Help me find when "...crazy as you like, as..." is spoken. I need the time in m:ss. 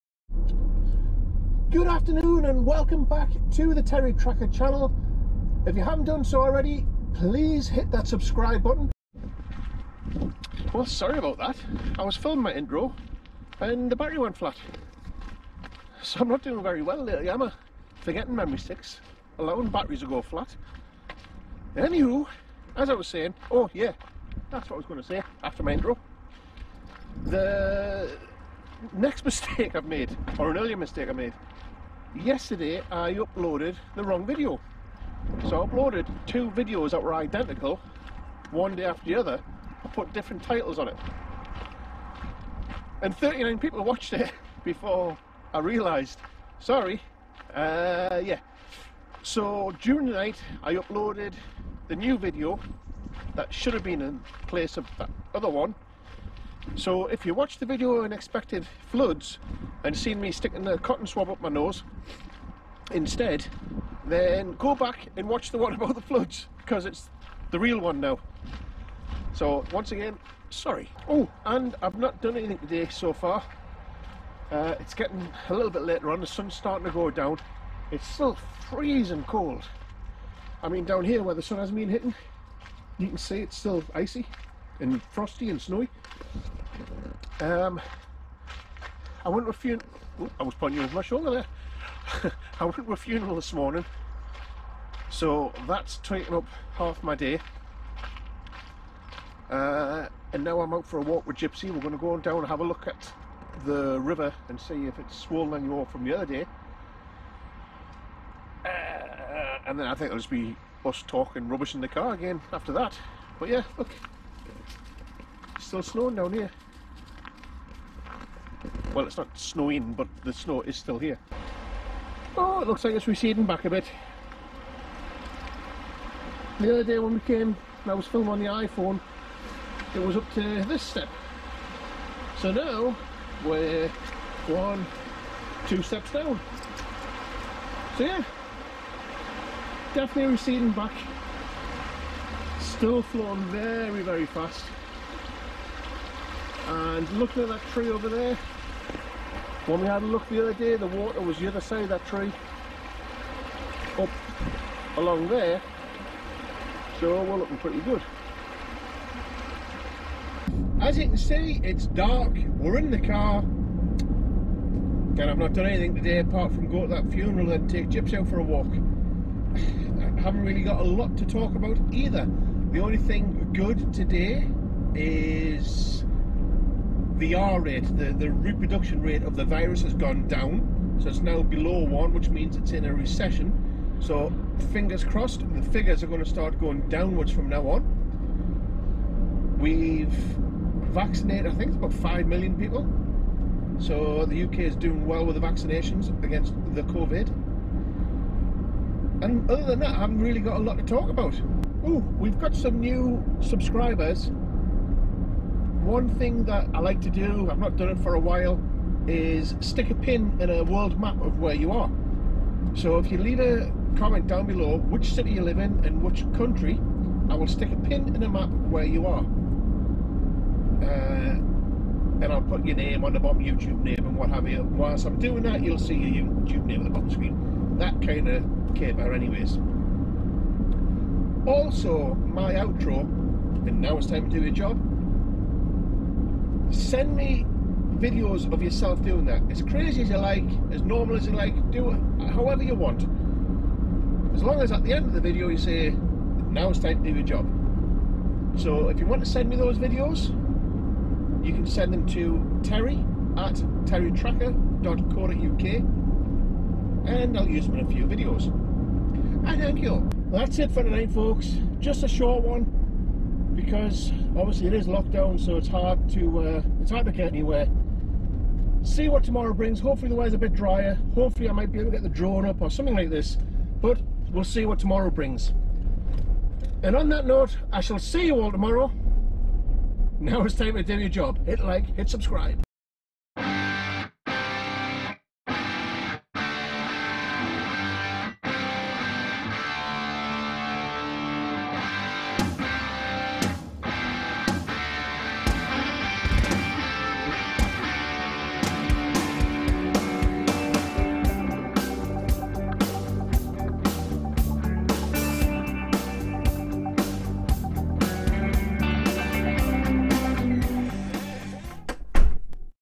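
3:59.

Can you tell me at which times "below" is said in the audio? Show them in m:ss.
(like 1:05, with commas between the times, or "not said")
3:01, 3:34.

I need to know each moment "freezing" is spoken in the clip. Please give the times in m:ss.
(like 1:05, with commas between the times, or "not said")
1:18.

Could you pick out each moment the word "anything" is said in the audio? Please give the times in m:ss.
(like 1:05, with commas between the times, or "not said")
1:12, 2:45.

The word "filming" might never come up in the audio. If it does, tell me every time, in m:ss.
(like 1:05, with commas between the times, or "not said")
0:12, 2:08.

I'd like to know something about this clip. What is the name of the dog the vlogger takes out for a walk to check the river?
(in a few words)
Gypsy.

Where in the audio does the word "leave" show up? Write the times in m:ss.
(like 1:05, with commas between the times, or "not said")
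3:33.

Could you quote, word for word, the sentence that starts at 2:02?
Oh, it looks like it's receding back a bit.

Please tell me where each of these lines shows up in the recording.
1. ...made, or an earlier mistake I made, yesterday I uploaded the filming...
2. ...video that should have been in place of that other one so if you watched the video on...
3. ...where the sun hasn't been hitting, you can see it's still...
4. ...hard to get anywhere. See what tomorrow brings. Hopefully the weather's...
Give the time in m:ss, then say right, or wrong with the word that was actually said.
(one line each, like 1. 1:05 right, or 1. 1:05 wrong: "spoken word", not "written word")
1. 0:29 wrong: "wrong", not "filming"
2. 0:52 right
3. 1:21 right
4. 4:26 right.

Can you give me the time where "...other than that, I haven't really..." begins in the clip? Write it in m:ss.
3:19.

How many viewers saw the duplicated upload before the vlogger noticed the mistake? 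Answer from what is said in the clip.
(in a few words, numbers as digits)
39.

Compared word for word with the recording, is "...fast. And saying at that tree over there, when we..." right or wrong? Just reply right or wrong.
wrong.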